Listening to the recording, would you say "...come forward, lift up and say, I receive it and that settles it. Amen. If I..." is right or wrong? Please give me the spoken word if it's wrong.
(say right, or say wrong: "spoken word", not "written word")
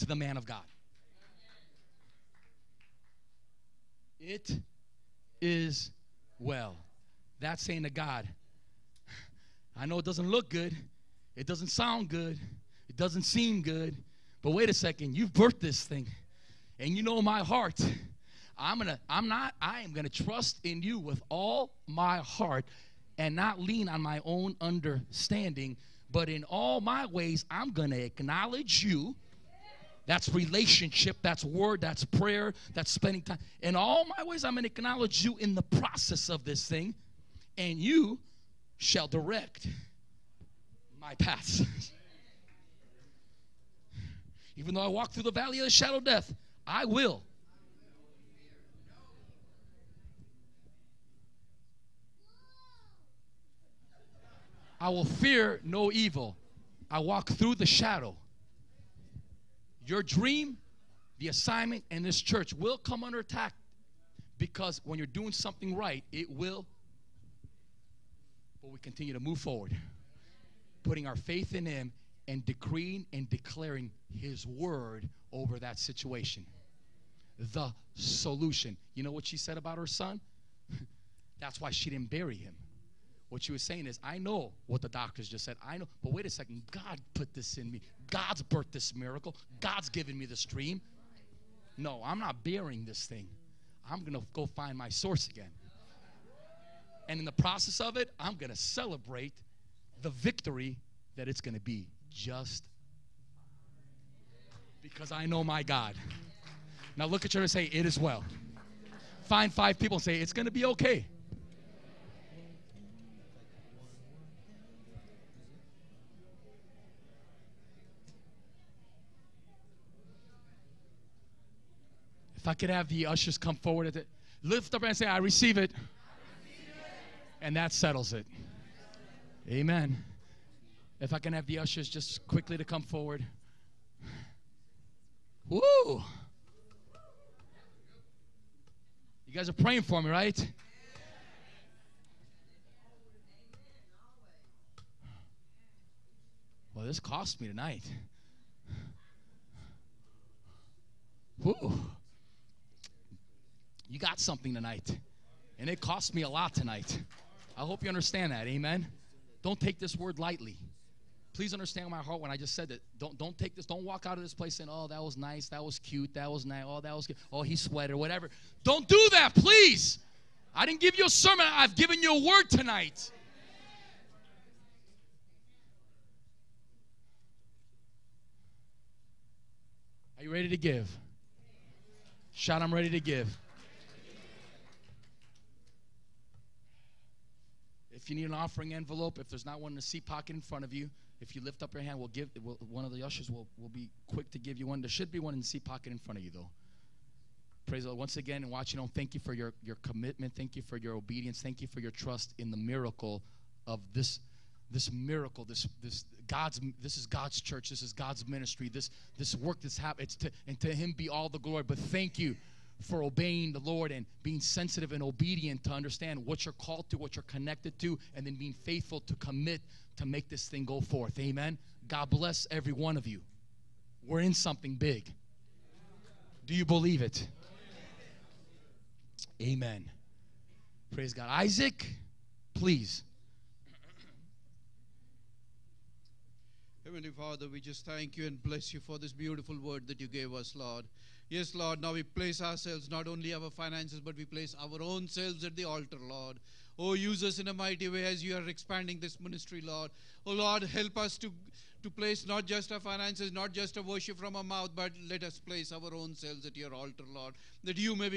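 right.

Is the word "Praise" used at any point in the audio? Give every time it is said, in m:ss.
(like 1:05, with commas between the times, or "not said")
3:17, 3:50.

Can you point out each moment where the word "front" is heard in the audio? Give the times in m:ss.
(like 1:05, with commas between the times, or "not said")
3:10, 3:15.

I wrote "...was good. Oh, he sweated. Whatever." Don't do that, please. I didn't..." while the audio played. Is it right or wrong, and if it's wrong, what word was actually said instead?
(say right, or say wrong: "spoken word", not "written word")
right.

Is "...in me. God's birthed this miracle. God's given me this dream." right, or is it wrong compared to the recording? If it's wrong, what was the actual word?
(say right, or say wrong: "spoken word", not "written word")
right.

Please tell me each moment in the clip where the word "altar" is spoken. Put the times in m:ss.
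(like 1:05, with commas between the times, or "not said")
4:05, 4:16.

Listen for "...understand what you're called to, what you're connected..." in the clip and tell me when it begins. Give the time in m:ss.
3:35.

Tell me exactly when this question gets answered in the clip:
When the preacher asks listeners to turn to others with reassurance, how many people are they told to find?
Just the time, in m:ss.
1:49.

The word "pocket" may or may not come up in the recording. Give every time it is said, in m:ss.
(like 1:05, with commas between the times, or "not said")
3:10, 3:15.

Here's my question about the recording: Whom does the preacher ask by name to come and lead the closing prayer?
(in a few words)
Isaac.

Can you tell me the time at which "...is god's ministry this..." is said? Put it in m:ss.
3:27.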